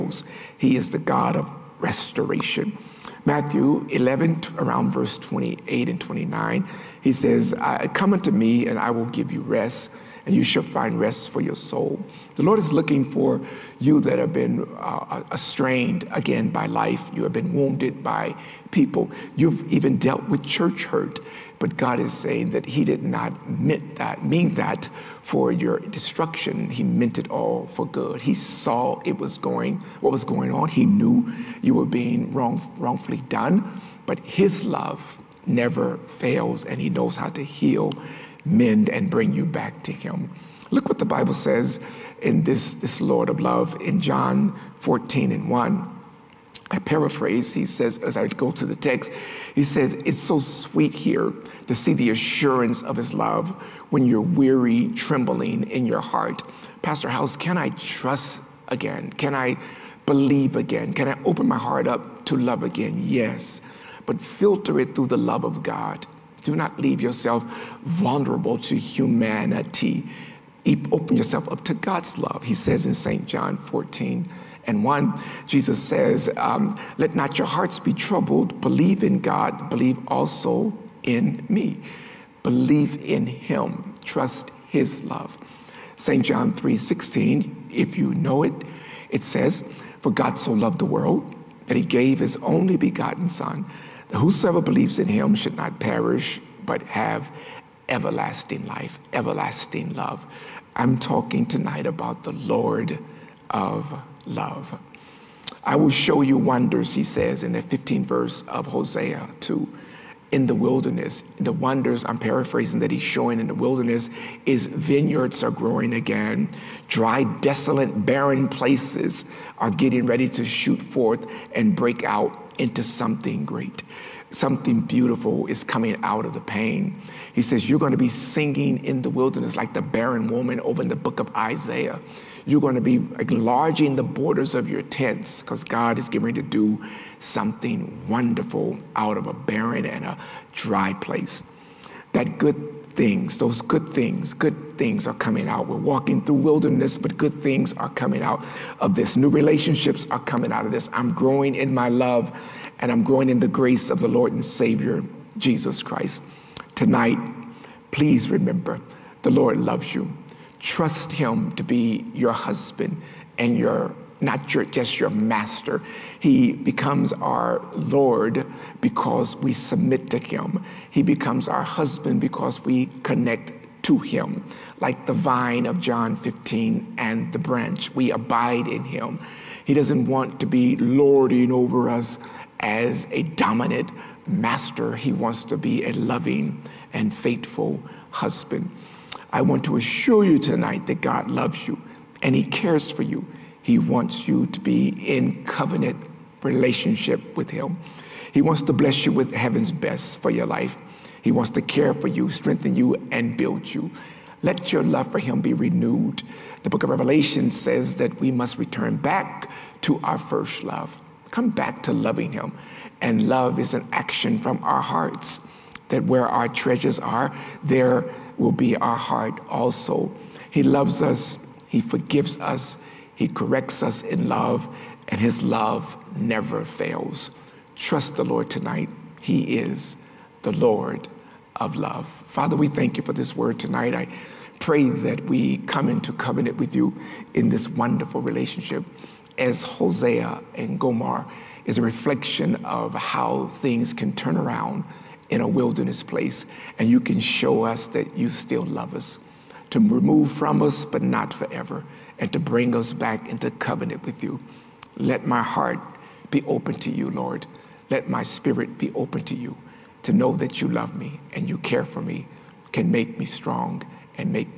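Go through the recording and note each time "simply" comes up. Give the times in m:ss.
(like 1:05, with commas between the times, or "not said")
not said.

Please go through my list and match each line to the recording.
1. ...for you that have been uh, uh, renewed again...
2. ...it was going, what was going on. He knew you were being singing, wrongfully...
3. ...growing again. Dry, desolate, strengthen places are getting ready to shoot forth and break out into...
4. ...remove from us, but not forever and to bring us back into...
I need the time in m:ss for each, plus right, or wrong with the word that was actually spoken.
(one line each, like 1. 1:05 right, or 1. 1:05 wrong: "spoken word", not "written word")
1. 0:13 wrong: "strained", not "renewed"
2. 0:29 wrong: "wrong", not "singing"
3. 1:55 wrong: "barren", not "strengthen"
4. 4:09 right.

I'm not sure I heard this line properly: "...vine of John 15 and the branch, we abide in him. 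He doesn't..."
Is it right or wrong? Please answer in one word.
right.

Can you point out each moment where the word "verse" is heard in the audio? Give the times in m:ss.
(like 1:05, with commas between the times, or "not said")
0:04, 1:48.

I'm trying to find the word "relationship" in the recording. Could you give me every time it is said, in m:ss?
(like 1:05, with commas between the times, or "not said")
2:29, 3:16, 3:58.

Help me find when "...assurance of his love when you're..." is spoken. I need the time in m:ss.
0:52.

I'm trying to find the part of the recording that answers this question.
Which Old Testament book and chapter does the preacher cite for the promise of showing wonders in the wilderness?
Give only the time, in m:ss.
1:48.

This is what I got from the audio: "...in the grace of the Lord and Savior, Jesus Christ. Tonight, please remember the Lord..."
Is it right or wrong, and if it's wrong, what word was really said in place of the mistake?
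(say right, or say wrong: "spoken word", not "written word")
right.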